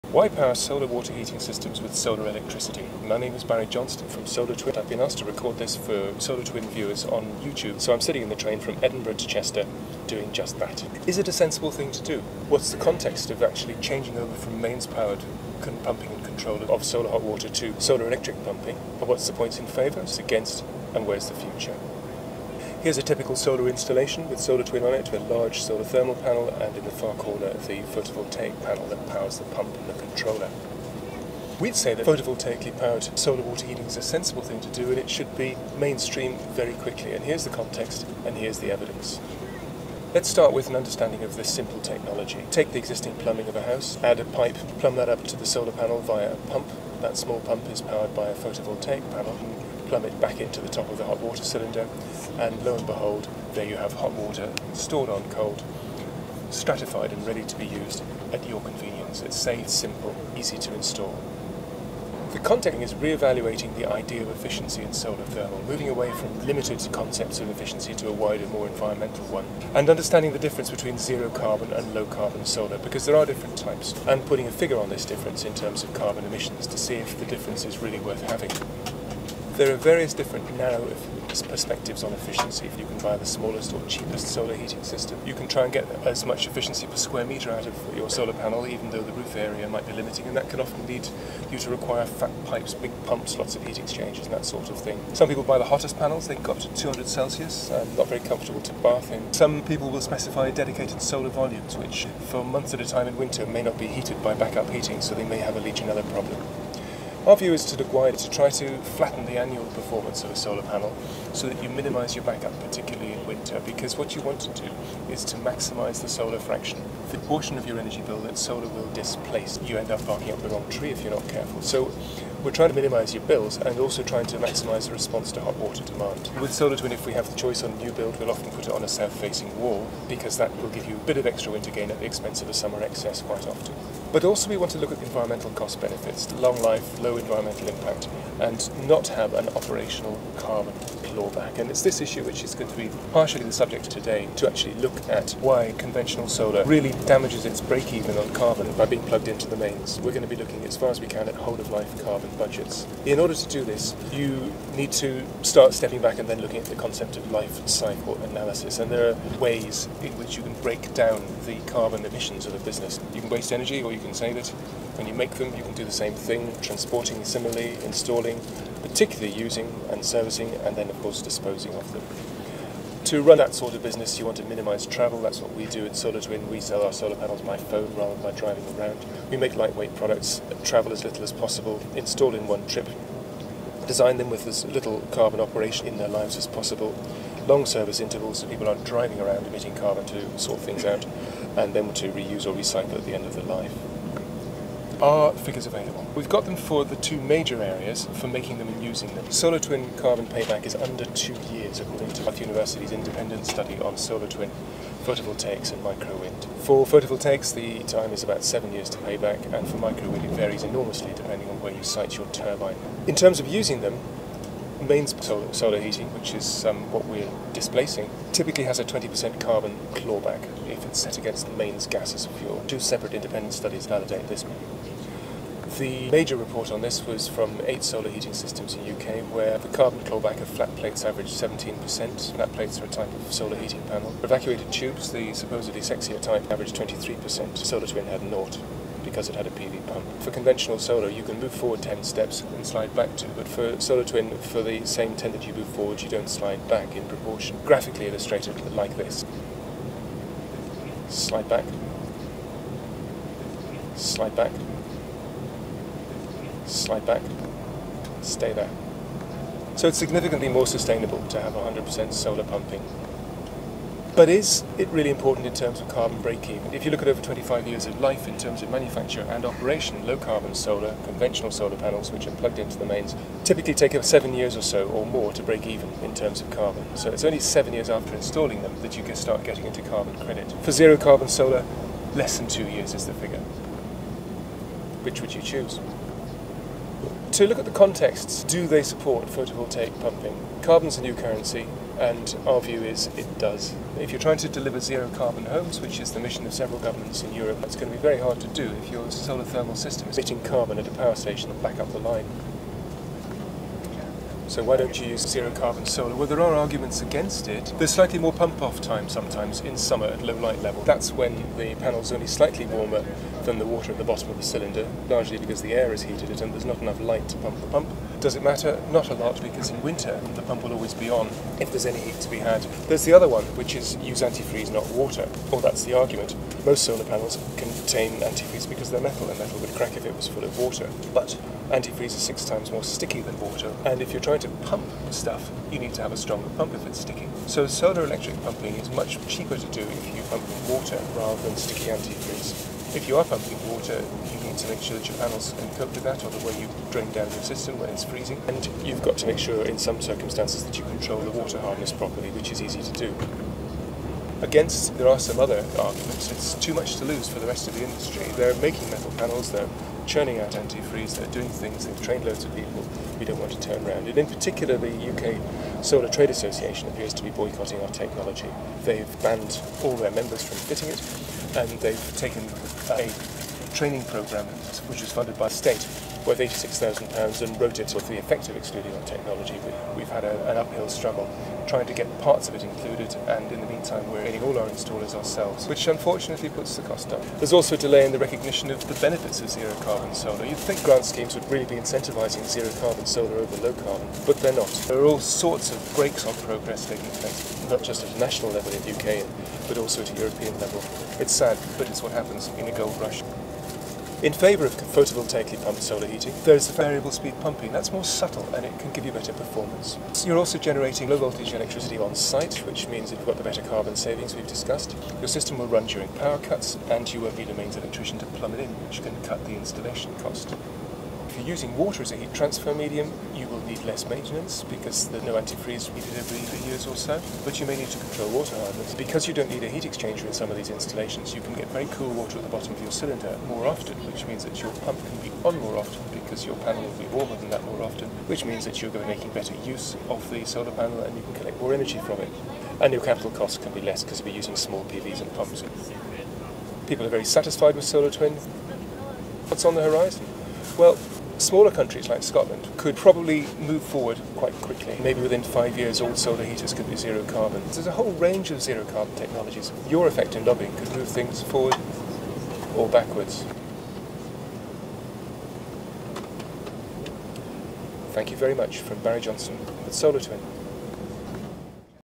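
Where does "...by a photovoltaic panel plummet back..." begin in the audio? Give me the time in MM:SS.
00:48.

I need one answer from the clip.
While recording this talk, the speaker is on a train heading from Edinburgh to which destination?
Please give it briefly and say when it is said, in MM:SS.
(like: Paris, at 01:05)
Chester, at 00:09.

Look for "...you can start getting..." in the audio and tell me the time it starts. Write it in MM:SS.
04:38.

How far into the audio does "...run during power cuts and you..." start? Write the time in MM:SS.
06:55.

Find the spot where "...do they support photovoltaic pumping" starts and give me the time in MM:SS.
04:48.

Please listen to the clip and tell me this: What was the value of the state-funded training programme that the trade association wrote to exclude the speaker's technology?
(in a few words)
£86,000.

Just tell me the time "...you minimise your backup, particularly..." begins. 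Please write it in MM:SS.
01:51.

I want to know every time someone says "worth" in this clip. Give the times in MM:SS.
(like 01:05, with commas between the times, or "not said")
01:17, 06:16.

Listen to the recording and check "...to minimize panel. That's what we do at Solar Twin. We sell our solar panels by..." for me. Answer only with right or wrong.
wrong.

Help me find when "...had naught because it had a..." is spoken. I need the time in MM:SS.
03:58.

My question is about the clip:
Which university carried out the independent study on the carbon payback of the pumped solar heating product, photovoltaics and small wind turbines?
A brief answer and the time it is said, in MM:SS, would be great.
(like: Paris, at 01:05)
Bath University, at 03:22.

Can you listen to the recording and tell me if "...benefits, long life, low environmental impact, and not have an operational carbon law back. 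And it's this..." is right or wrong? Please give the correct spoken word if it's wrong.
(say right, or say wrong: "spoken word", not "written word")
right.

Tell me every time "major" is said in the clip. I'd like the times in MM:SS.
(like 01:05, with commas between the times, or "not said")
03:17, 03:46.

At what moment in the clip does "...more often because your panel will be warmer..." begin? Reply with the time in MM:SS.
07:15.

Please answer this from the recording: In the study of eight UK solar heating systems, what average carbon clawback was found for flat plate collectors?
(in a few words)
17%.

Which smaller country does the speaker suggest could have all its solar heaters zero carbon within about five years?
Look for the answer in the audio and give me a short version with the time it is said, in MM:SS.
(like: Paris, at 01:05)
Scotland, at 07:32.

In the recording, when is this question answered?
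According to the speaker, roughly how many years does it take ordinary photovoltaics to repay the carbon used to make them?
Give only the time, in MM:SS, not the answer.
03:28.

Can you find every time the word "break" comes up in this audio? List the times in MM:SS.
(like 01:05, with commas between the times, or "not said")
02:27, 02:40, 04:26, 04:35.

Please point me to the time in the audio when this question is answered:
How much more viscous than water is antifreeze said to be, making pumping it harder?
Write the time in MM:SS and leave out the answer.
05:32.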